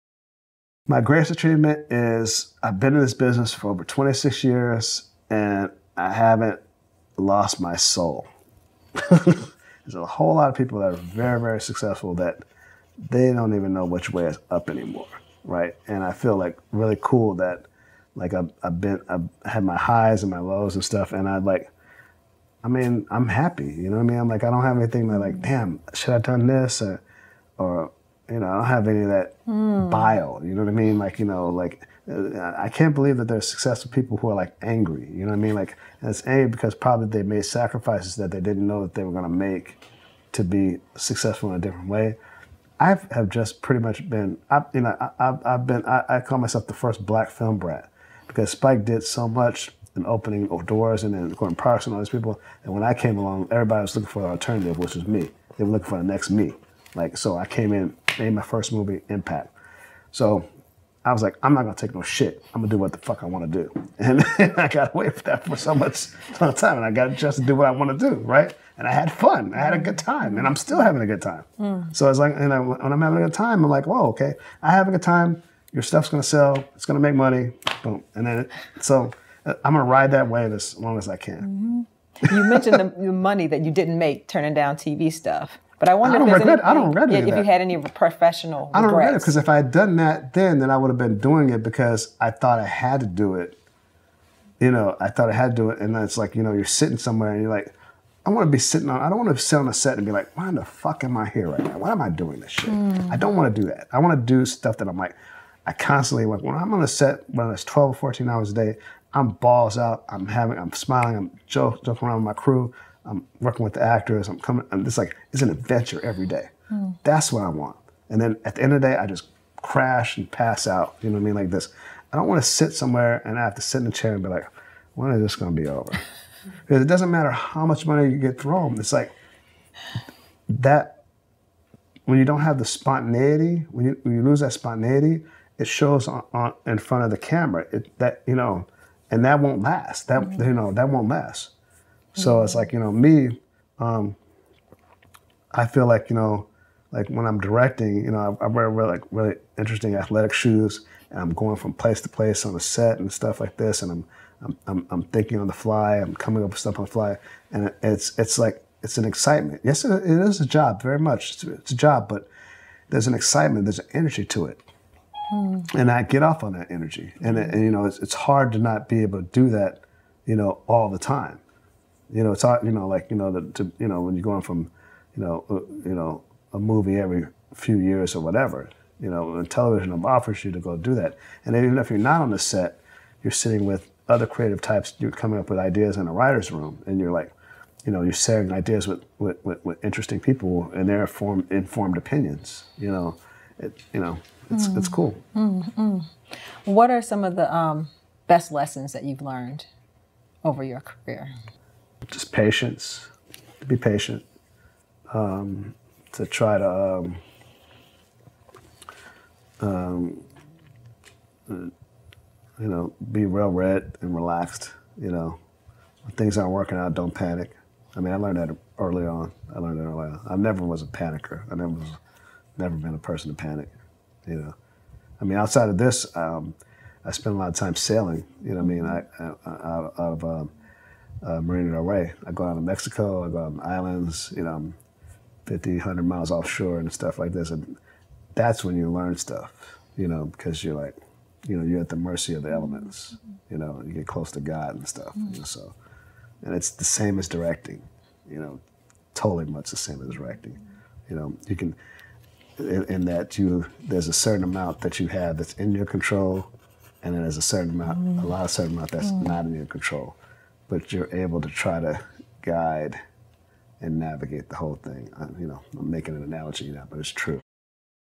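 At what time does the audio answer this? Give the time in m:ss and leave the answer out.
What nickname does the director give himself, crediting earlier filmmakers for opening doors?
0:46.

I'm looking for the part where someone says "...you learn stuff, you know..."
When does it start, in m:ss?
3:58.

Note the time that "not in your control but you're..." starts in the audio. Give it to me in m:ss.
4:19.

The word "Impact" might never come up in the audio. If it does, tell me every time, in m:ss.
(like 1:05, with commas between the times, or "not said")
0:59.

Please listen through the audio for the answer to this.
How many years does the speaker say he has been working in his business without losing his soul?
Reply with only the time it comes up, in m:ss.
0:03.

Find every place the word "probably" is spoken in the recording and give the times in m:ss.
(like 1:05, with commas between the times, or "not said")
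0:36.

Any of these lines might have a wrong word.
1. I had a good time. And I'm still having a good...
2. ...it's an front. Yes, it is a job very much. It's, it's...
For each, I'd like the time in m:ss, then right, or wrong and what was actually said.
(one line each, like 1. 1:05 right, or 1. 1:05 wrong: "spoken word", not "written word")
1. 1:09 right
2. 2:38 wrong: "excitement", not "front".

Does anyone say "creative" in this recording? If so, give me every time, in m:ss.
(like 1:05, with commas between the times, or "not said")
3:04.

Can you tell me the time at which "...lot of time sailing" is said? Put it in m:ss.
3:47.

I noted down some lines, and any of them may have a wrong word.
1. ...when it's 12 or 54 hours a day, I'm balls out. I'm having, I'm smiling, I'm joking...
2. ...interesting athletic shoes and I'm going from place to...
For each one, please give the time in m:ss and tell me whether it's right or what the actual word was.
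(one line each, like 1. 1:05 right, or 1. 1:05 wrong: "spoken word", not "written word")
1. 1:47 wrong: "14", not "54"
2. 2:29 right.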